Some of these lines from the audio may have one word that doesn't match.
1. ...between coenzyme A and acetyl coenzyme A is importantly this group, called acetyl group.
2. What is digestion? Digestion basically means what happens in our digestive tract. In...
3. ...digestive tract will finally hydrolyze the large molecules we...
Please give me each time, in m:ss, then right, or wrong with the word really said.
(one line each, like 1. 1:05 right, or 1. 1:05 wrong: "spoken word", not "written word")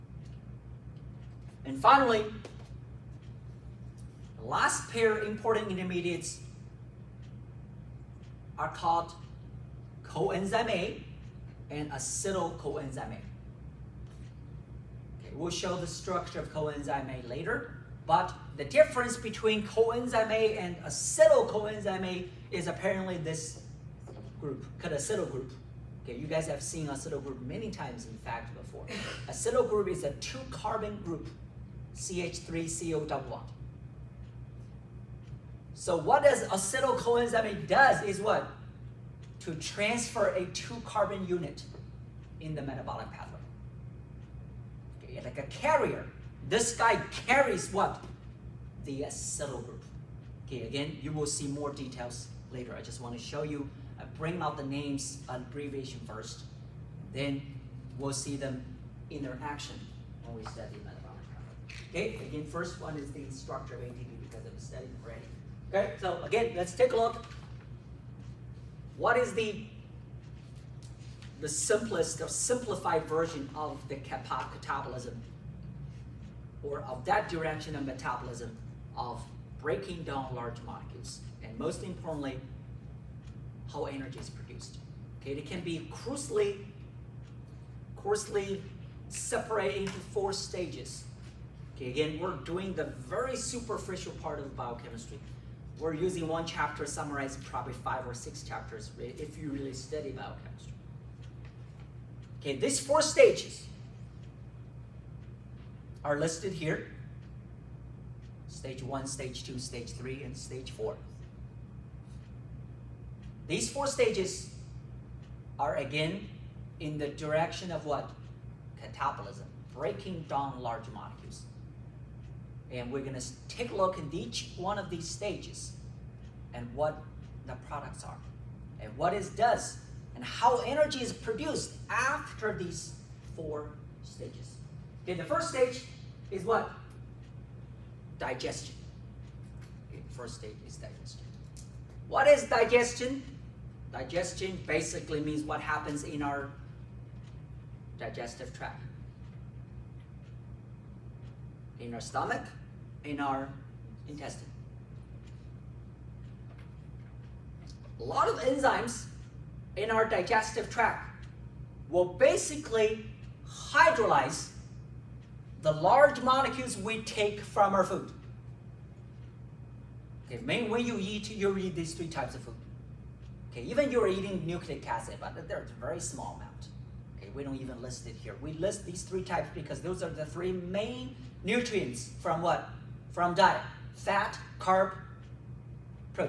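1. 0:19 wrong: "apparently", not "importantly"
2. 2:22 right
3. 2:40 wrong: "basically", not "finally".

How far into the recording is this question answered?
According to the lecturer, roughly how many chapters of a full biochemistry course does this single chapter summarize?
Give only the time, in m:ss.
1:37.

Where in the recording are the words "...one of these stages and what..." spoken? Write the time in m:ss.
2:04.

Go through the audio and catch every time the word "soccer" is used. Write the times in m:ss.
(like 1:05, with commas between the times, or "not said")
not said.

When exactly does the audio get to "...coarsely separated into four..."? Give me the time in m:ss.
1:27.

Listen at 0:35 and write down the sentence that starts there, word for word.
So what does acetyl coenzyme A does is what?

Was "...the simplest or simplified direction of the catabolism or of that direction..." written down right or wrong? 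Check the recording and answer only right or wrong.
wrong.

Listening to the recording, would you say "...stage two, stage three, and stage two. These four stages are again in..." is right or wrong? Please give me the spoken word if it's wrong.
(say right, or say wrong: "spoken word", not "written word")
wrong: "four", not "two".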